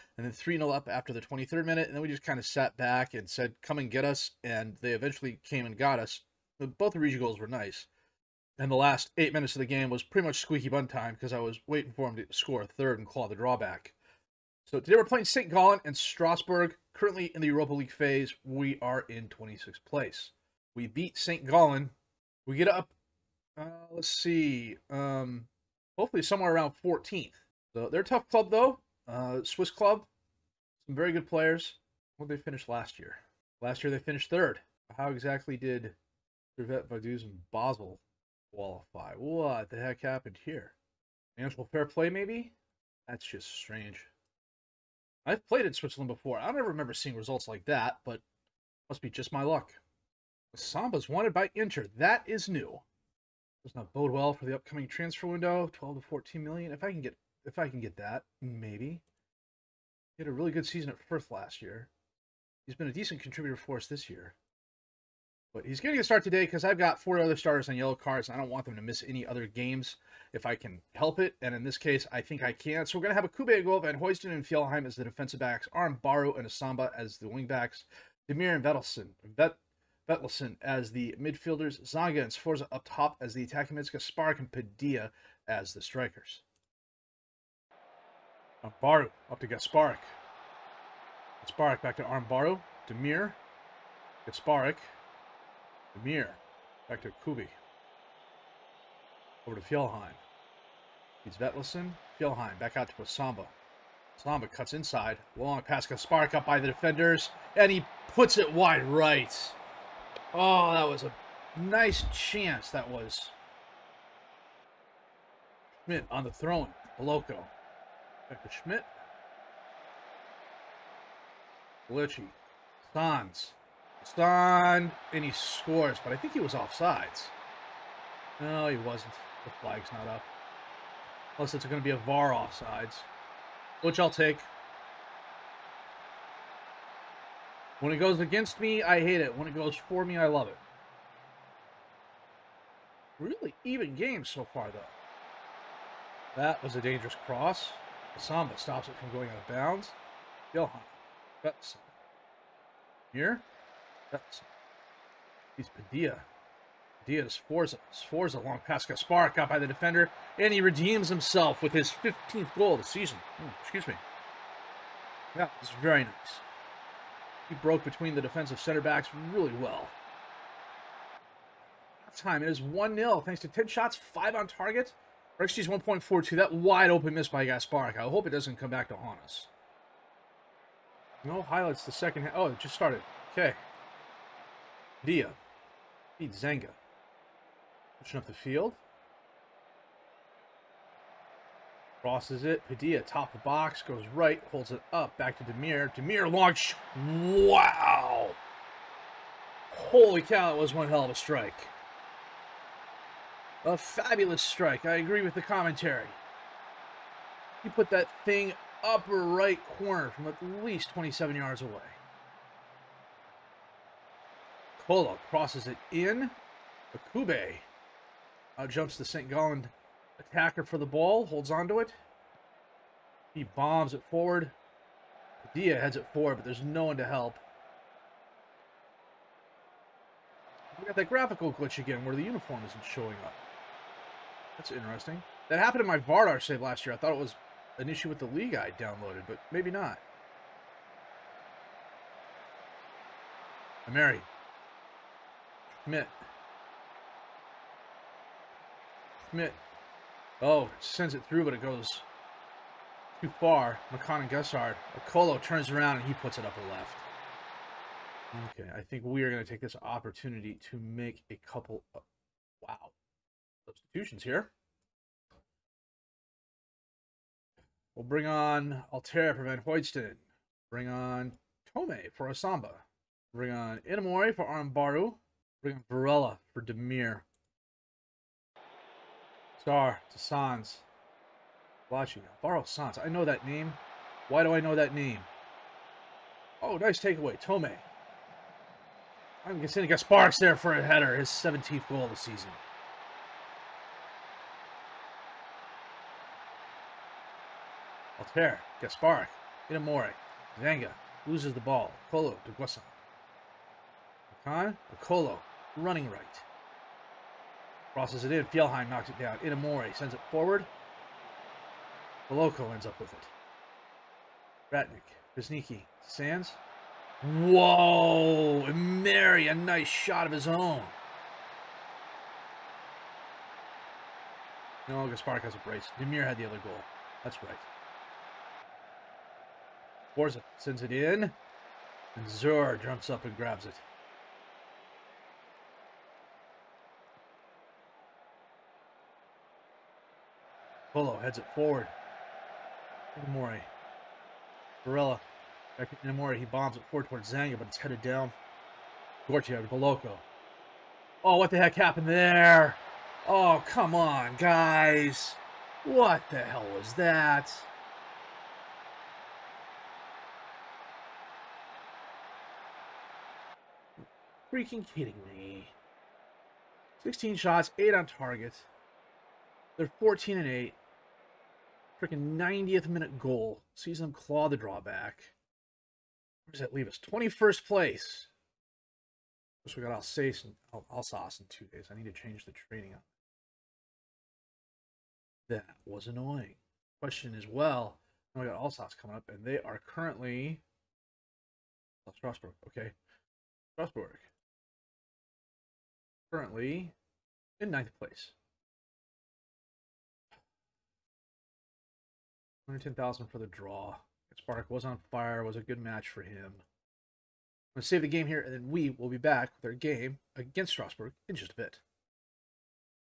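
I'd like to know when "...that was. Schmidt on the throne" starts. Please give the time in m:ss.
1:52.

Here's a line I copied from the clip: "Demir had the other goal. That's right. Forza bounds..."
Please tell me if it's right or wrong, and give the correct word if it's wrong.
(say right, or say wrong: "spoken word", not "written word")
wrong: "sends", not "bounds".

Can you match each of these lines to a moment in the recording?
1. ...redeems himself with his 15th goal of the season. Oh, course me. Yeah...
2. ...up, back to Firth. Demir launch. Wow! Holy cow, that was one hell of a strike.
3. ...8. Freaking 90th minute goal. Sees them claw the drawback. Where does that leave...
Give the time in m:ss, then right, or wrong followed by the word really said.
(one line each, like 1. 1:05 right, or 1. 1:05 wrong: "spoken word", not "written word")
1. 2:40 wrong: "excuse", not "course"
2. 3:14 wrong: "Demir", not "Firth"
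3. 6:10 right.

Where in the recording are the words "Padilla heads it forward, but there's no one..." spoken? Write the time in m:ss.
3:45.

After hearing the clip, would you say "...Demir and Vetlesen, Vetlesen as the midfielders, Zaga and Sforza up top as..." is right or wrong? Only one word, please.
right.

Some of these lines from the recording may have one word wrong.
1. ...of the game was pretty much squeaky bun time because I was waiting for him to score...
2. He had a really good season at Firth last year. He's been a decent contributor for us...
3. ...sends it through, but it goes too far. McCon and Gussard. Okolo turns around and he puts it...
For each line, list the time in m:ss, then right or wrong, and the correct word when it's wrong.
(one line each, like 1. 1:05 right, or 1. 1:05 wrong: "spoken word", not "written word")
1. 0:09 right
2. 1:00 right
3. 4:10 right.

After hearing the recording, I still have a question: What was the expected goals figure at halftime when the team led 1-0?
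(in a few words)
1.42.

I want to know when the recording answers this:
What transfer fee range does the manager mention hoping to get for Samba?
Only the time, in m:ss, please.
0:55.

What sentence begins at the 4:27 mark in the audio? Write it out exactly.
We'll bring on Altera for Van Hoydston.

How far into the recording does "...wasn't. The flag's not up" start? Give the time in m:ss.
2:08.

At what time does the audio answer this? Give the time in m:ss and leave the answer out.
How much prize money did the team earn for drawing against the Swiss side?
6:42.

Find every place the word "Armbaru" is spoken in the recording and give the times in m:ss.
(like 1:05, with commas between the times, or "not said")
1:32, 4:34.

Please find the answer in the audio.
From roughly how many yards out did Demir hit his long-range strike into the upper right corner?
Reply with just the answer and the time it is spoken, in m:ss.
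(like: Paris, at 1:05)
27 yards, at 3:30.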